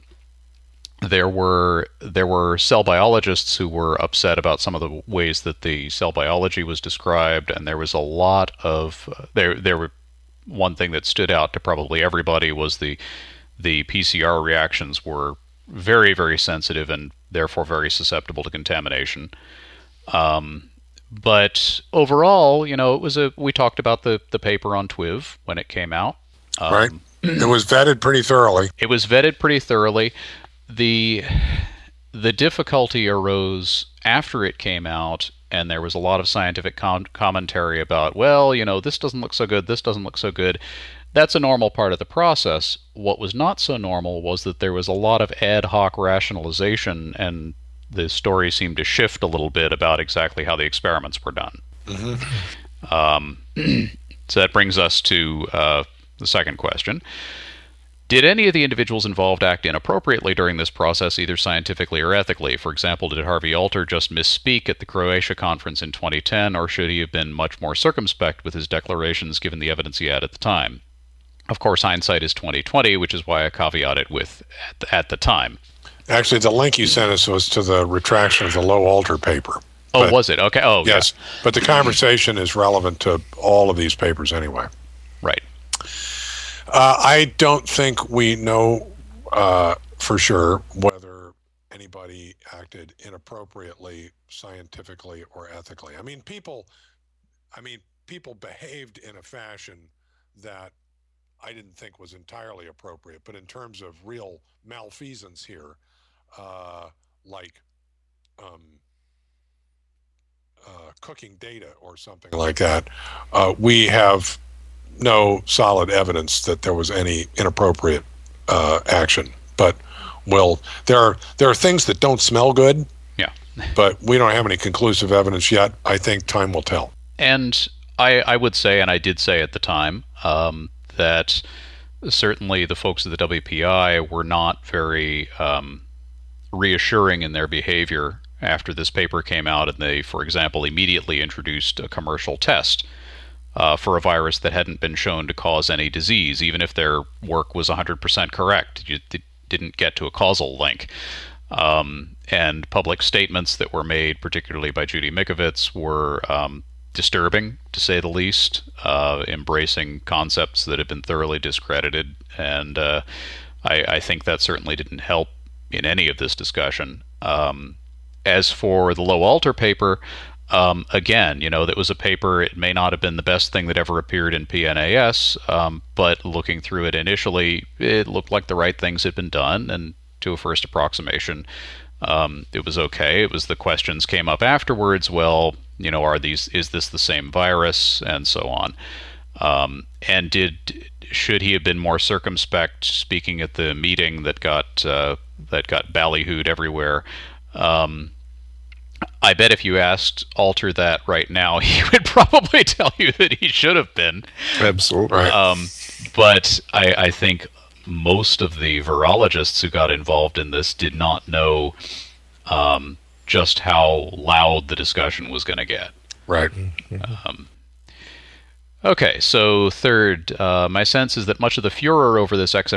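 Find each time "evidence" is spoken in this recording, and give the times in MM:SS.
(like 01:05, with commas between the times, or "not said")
01:09, 01:55, 02:05.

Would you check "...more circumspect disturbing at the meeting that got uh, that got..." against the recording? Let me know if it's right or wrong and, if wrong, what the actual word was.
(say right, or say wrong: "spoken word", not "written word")
wrong: "speaking", not "disturbing".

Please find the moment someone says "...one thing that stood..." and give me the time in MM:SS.
00:10.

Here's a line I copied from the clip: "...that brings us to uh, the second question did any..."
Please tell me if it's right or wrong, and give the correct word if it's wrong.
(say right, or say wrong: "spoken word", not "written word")
right.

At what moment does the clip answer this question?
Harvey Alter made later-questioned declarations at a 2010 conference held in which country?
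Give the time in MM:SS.
01:04.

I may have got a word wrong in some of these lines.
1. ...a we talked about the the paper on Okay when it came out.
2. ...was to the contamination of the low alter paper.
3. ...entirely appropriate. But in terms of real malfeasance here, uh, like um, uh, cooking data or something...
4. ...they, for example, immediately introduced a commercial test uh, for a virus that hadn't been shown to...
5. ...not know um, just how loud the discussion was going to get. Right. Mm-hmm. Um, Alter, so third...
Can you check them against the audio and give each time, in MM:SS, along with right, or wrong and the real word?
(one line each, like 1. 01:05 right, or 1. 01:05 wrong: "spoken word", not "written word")
1. 00:23 wrong: "TWIV", not "Okay"
2. 01:17 wrong: "retraction", not "contamination"
3. 01:42 right
4. 02:19 right
5. 03:30 wrong: "Okay", not "Alter".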